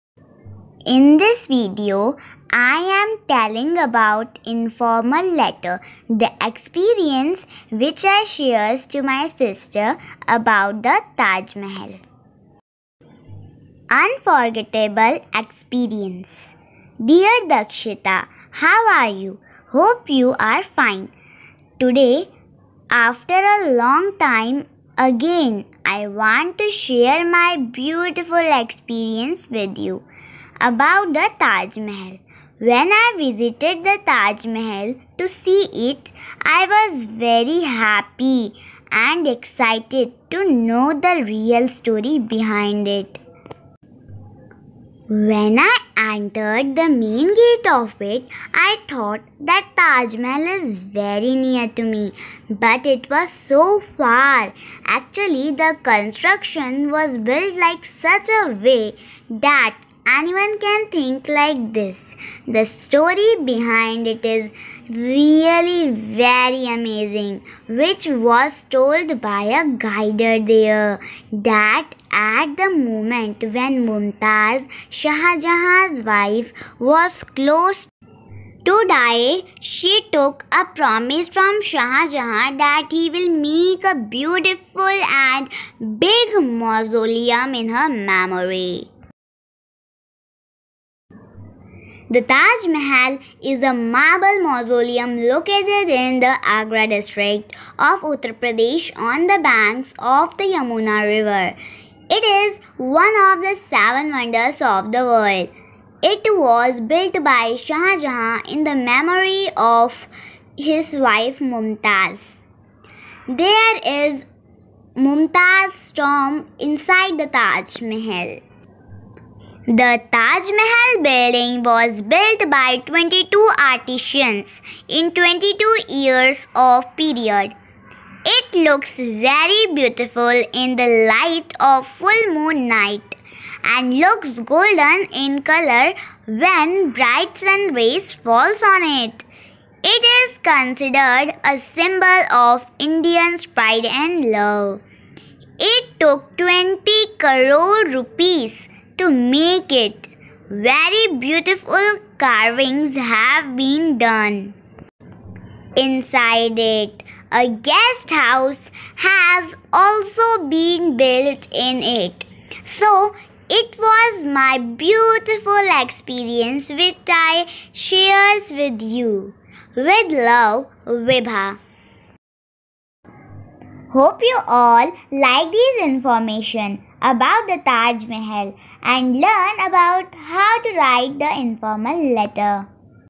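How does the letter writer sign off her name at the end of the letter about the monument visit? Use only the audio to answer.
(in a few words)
Vibha.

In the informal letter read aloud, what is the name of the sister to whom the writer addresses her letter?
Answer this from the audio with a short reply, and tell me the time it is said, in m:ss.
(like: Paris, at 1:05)
Dakshita, at 0:17.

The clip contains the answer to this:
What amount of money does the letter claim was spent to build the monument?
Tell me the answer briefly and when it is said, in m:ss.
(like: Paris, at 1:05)
20 crore rupees, at 2:26.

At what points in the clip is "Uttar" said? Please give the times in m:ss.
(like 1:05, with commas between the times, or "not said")
1:38.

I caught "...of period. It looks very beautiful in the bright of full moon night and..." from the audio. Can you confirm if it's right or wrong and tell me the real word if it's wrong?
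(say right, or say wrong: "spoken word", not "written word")
wrong: "light", not "bright".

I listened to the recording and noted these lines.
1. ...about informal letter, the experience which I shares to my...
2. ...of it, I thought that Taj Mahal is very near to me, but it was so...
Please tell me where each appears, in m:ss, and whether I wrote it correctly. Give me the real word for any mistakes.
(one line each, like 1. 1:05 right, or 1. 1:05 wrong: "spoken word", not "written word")
1. 0:03 right
2. 0:47 right.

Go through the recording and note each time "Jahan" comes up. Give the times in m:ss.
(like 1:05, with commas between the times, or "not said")
1:15, 1:22, 1:48.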